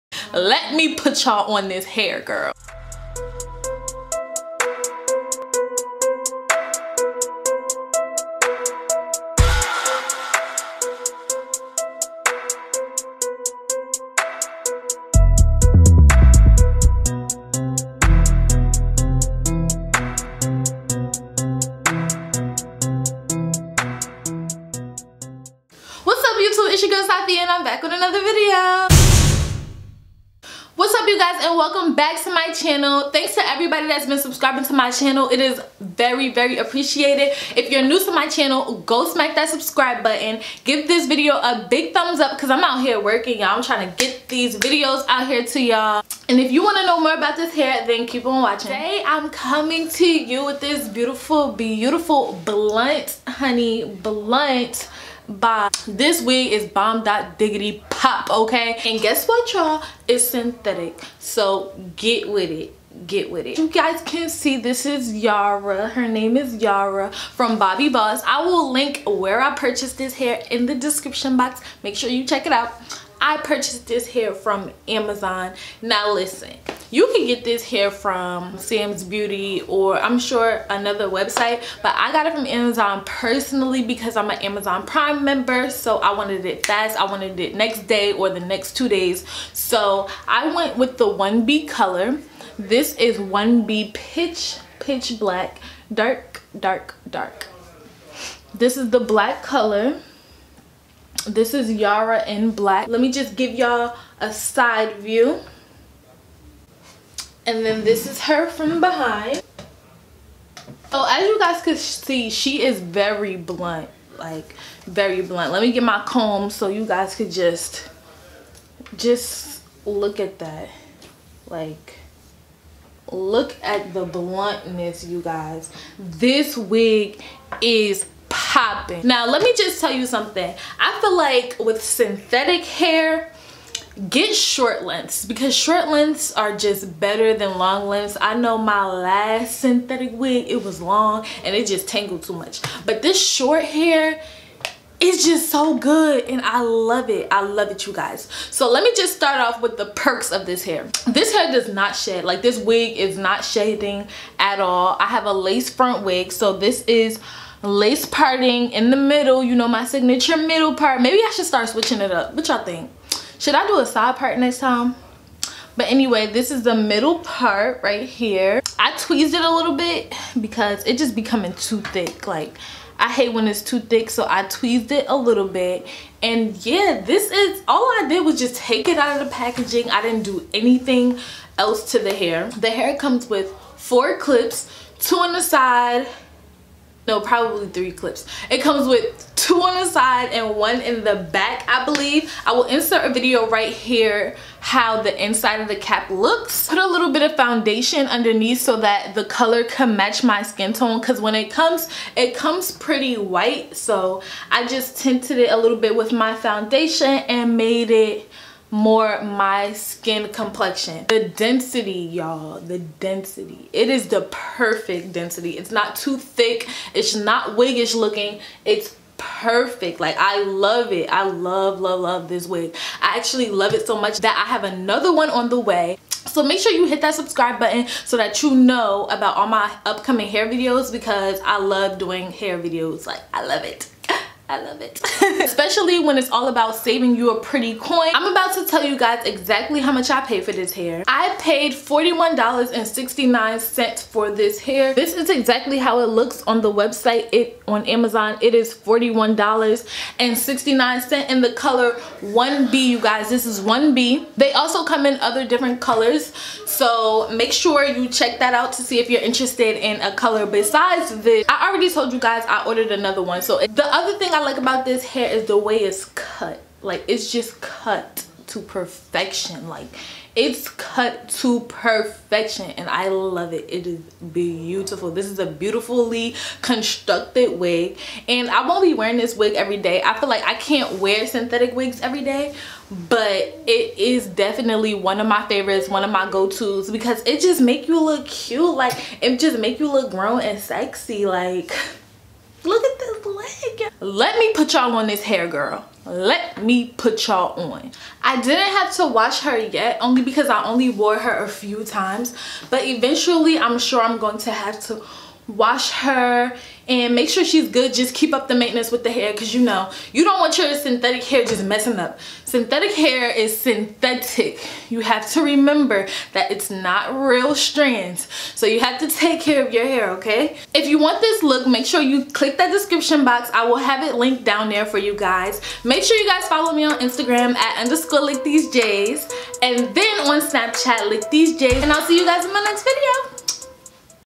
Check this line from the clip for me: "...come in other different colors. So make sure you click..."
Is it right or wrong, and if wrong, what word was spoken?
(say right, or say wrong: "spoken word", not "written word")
wrong: "check", not "click".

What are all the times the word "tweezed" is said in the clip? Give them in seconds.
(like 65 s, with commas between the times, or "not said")
168 s, 174 s.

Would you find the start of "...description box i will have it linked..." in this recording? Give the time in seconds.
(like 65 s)
322 s.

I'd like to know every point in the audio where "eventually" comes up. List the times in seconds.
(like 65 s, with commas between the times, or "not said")
302 s.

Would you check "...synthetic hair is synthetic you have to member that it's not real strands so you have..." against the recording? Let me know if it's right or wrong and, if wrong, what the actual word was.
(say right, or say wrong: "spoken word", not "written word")
wrong: "remember", not "member".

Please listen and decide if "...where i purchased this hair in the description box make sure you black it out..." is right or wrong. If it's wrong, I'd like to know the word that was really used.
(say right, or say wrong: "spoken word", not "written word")
wrong: "check", not "black".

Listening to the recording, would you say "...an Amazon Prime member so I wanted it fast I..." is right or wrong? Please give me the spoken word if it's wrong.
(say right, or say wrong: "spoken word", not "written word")
right.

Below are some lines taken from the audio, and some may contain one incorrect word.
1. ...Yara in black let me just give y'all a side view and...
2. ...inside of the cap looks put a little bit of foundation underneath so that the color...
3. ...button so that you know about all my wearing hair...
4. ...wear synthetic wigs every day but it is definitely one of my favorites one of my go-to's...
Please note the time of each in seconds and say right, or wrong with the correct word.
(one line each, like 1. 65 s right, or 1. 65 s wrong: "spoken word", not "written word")
1. 101 s right
2. 195 s right
3. 227 s wrong: "upcoming", not "wearing"
4. 280 s right.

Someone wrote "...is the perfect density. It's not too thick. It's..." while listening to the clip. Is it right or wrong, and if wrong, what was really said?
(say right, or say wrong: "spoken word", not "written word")
right.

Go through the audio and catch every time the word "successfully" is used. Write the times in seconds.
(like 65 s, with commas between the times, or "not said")
not said.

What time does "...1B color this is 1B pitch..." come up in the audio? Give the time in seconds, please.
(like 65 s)
91 s.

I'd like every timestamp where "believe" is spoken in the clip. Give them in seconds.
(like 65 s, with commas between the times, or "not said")
191 s.